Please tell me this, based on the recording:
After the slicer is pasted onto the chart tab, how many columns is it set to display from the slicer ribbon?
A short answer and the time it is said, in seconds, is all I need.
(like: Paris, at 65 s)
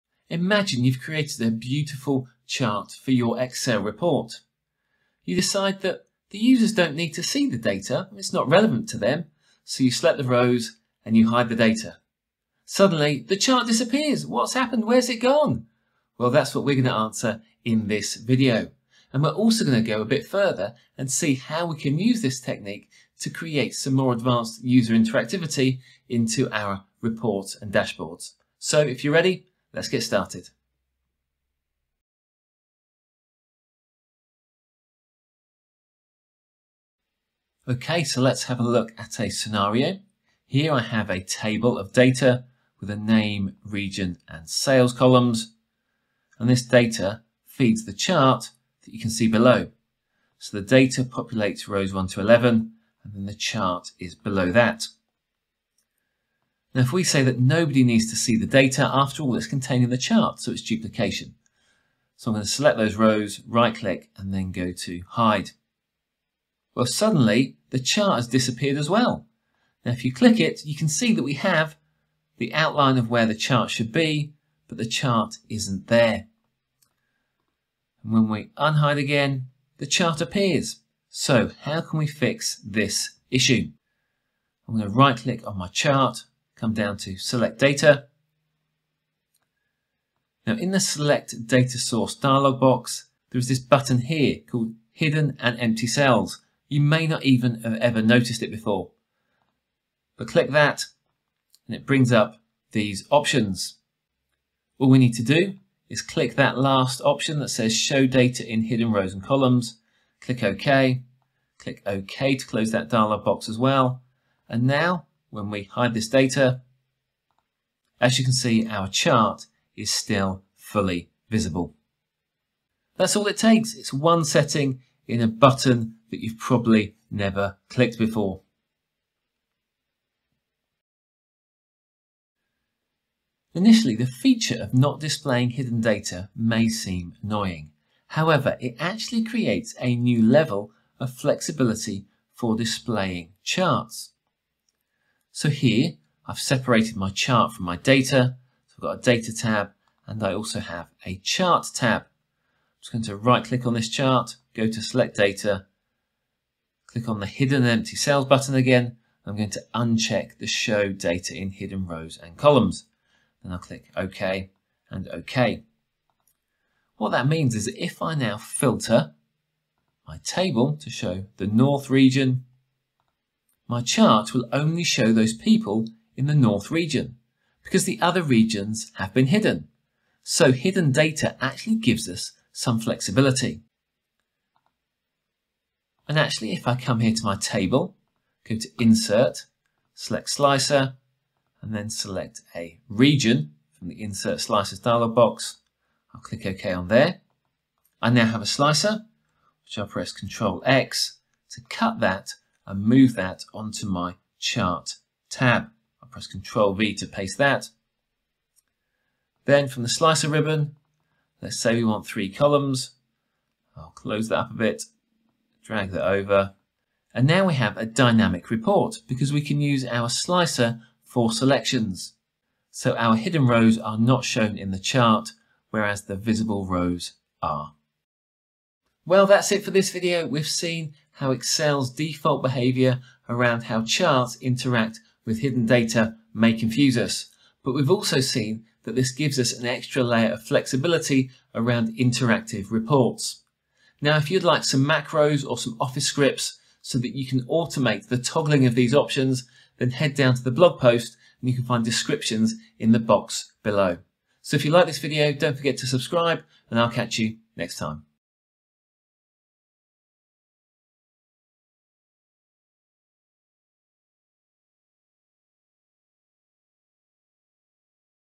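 3, at 212 s.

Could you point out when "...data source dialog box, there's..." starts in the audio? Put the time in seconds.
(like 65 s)
91 s.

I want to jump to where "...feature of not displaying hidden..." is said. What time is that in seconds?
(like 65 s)
134 s.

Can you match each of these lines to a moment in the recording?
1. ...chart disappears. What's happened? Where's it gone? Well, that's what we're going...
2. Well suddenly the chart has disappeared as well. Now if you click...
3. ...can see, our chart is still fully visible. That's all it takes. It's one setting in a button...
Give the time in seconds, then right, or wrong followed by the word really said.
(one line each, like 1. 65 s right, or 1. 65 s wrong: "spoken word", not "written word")
1. 13 s right
2. 66 s right
3. 118 s right.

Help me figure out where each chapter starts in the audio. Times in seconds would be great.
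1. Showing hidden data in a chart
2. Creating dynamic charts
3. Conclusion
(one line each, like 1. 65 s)
1. 35 s
2. 132 s
3. 227 s.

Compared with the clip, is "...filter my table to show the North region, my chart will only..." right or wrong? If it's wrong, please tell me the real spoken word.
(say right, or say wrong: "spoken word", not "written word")
right.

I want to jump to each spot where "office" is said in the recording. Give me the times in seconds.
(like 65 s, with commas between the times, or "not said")
245 s.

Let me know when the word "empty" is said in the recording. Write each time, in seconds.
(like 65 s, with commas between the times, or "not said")
95 s, 157 s.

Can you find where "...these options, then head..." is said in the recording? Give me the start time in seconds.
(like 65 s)
248 s.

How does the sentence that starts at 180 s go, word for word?
So hidden data actually gives us some flexibility.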